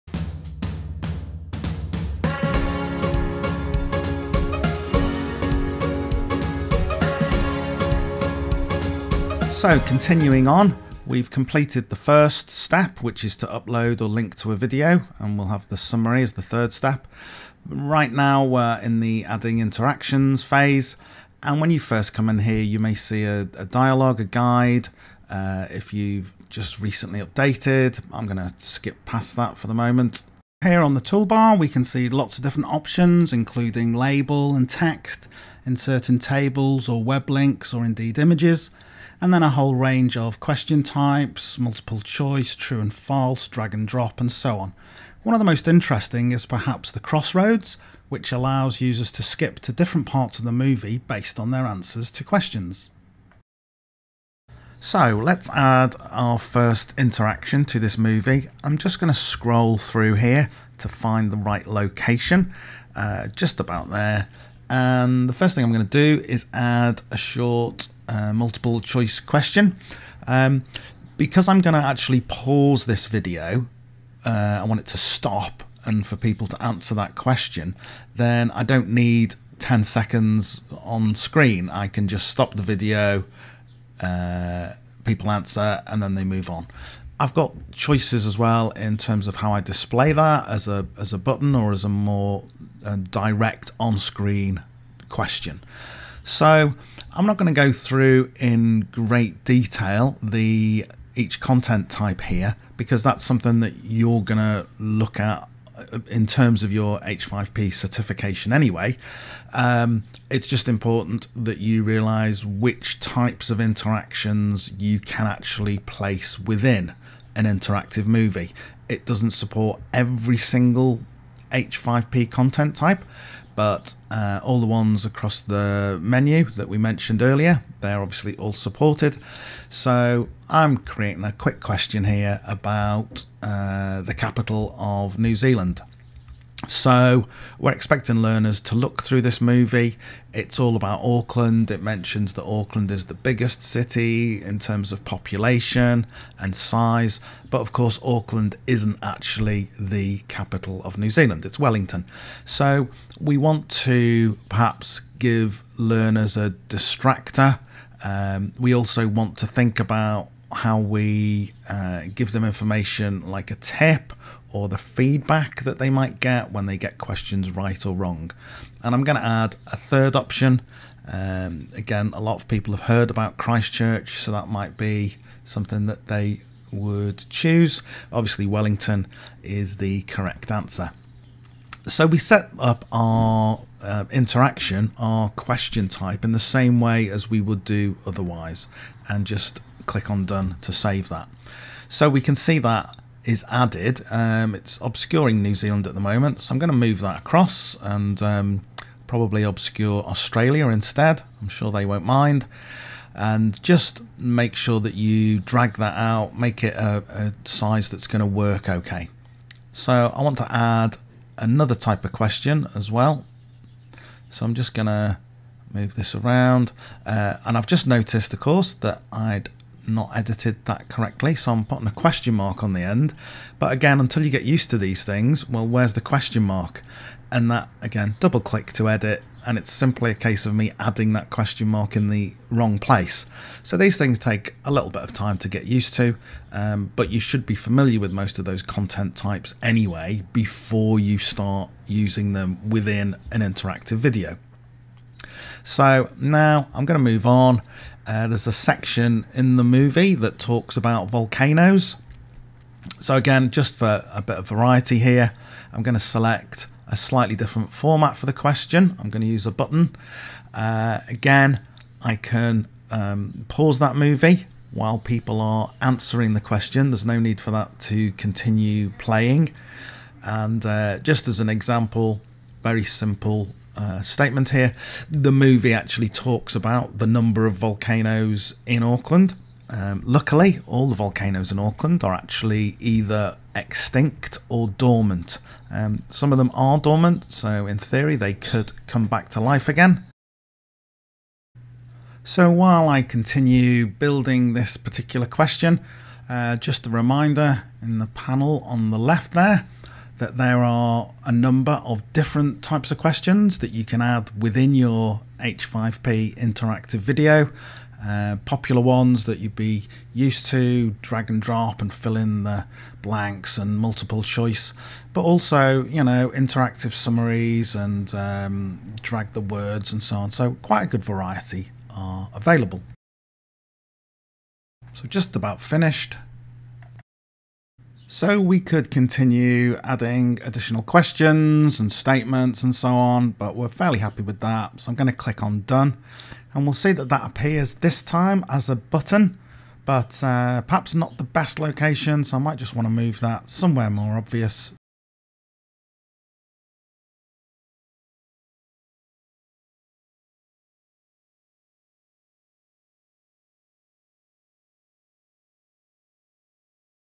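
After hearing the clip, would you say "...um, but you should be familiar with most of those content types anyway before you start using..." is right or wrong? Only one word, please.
right.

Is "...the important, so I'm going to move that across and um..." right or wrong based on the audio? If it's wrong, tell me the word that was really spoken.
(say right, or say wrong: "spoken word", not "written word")
wrong: "moment", not "important".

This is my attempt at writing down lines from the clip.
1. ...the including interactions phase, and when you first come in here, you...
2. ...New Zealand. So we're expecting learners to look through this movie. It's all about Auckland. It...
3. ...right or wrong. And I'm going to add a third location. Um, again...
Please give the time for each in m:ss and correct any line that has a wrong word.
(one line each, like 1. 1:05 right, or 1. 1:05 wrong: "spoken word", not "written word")
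1. 0:19 wrong: "adding", not "including"
2. 2:15 right
3. 2:47 wrong: "option", not "location".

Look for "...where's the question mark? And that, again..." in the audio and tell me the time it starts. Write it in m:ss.
3:45.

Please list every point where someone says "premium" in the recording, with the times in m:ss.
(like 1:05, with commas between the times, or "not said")
not said.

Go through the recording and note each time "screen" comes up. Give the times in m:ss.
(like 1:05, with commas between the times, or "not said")
1:21, 1:33.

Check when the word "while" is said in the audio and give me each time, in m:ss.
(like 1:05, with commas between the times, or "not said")
4:24, 4:52.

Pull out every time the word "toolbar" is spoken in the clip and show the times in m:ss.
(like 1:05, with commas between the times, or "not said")
0:31.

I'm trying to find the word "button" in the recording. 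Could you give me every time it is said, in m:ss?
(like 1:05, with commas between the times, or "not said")
1:31, 4:19, 5:38.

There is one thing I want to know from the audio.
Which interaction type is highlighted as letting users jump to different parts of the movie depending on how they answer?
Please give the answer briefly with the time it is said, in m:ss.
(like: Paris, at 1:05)
Crossroads, at 0:46.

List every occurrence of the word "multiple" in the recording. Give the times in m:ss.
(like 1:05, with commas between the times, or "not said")
0:41, 1:08, 5:13.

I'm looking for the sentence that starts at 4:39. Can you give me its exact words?
Um, luckily, all the volcanoes in Auckland are actually either extinct or dormant.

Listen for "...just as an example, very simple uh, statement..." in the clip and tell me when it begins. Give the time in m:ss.
4:30.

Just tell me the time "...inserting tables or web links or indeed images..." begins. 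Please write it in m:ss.
0:35.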